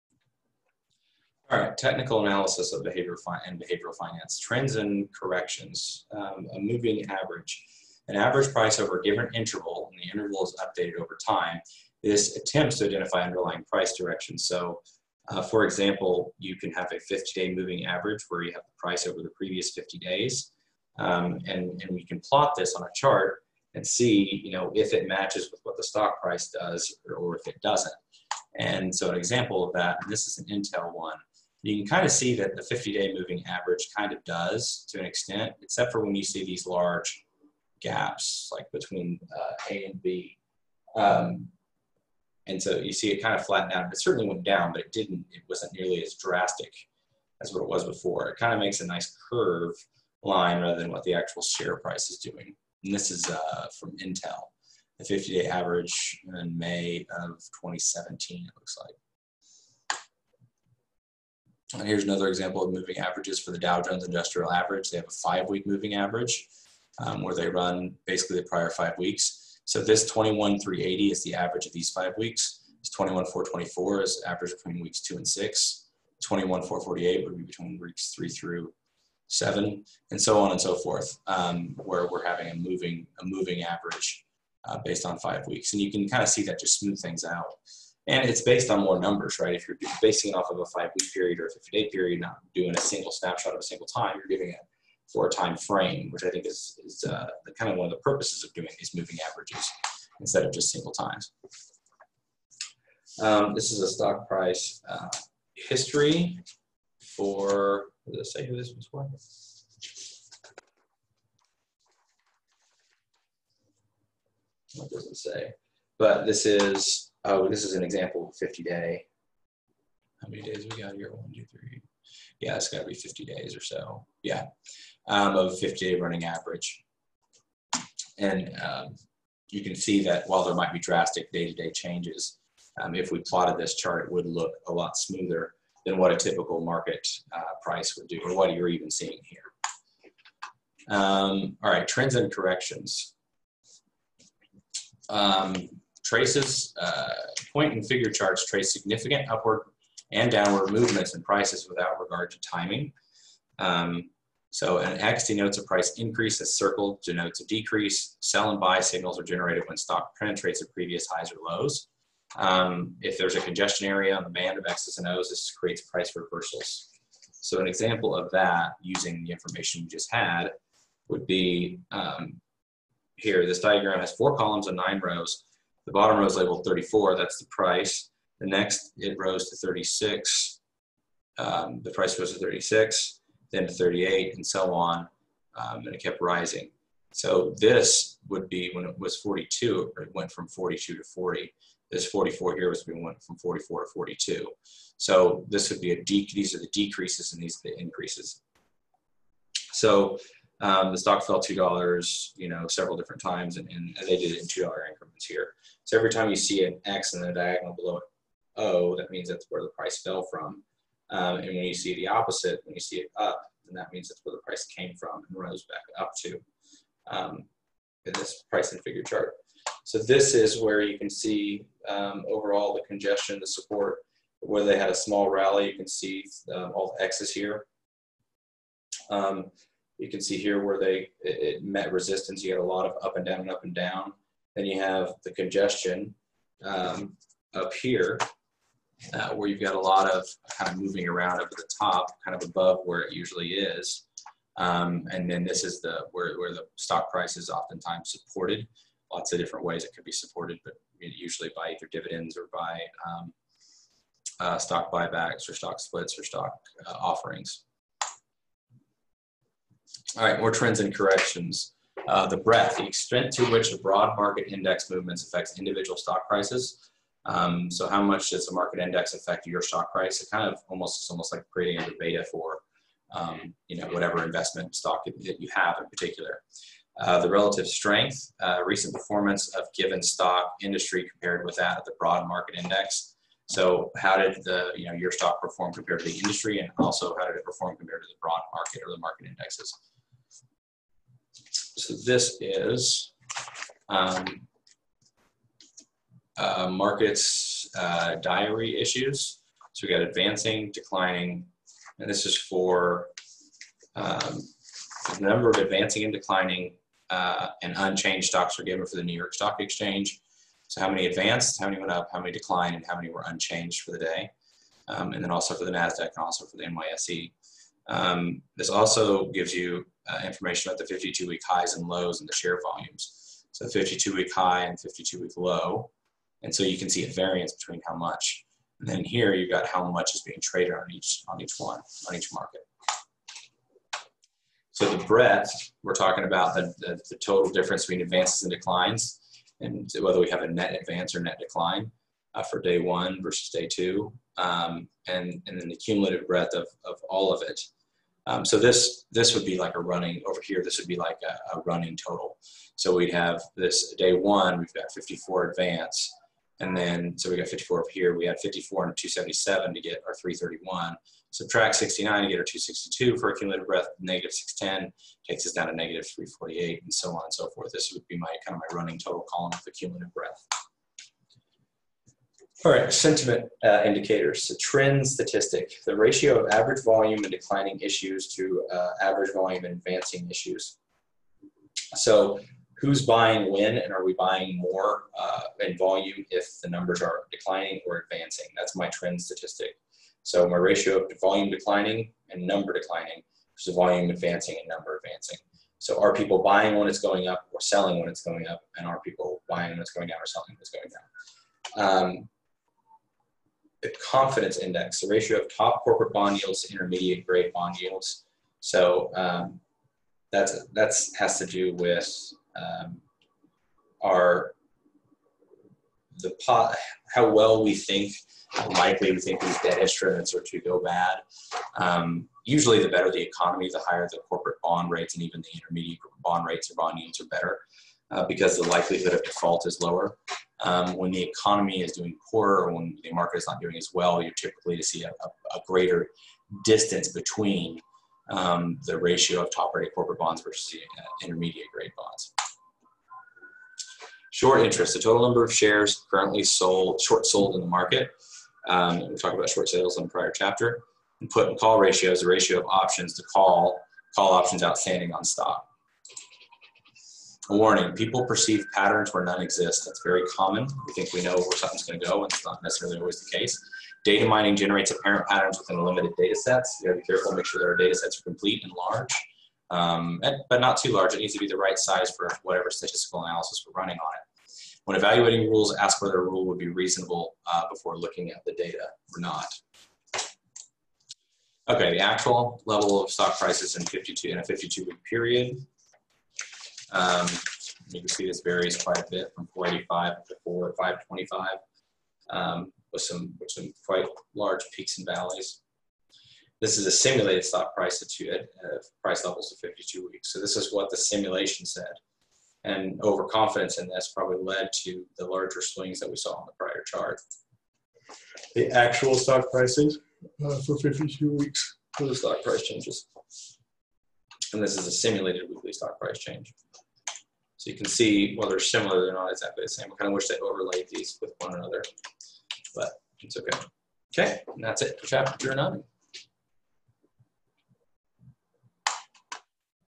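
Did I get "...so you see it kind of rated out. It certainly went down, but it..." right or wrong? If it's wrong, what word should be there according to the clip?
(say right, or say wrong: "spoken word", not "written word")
wrong: "flattened", not "rated".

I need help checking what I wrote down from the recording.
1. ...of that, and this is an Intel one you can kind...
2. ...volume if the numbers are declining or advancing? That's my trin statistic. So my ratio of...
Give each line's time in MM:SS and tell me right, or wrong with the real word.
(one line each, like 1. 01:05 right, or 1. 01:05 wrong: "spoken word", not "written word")
1. 00:29 right
2. 06:25 right.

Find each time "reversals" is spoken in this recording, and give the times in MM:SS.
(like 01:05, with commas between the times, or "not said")
02:46.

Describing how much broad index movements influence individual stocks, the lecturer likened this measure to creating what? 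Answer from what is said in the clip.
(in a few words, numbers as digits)
a beta.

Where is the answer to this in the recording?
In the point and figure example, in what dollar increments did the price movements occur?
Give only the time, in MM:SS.
03:24.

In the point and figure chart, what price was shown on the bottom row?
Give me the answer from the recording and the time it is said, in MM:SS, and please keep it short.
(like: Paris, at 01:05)
34, at 02:56.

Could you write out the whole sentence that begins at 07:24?
Short interest, the total number of shares currently sold, short sold in the market.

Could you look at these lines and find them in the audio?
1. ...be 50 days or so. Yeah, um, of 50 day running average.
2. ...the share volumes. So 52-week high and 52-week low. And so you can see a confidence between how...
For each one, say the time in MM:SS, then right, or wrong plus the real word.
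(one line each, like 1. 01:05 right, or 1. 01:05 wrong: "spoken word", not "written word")
1. 02:02 right
2. 05:22 wrong: "variance", not "confidence".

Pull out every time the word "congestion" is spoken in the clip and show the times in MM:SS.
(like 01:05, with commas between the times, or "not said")
02:43, 03:42, 03:55.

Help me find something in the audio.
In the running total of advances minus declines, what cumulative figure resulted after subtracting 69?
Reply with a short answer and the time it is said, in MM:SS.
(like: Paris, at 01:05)
262, at 06:02.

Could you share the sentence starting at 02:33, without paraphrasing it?
Um, so an X denotes a price increase, a circle denotes a decrease.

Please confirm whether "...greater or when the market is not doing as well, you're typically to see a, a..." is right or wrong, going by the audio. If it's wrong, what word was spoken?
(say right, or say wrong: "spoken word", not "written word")
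wrong: "poorer", not "greater".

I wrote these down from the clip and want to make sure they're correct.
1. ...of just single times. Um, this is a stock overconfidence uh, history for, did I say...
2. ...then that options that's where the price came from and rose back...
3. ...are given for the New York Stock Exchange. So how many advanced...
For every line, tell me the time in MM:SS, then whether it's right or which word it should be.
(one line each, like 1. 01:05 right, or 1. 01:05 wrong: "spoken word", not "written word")
1. 01:40 wrong: "price", not "overconfidence"
2. 03:33 wrong: "means", not "options"
3. 05:08 right.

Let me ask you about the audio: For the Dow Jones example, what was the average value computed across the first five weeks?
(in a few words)
21,380.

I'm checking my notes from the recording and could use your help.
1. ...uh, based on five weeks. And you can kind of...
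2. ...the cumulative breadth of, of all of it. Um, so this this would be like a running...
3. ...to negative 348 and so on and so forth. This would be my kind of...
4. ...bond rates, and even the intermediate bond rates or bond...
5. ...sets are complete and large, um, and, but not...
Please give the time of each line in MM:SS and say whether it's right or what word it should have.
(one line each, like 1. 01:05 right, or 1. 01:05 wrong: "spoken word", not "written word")
1. 01:24 right
2. 05:45 right
3. 06:05 right
4. 07:04 right
5. 07:47 right.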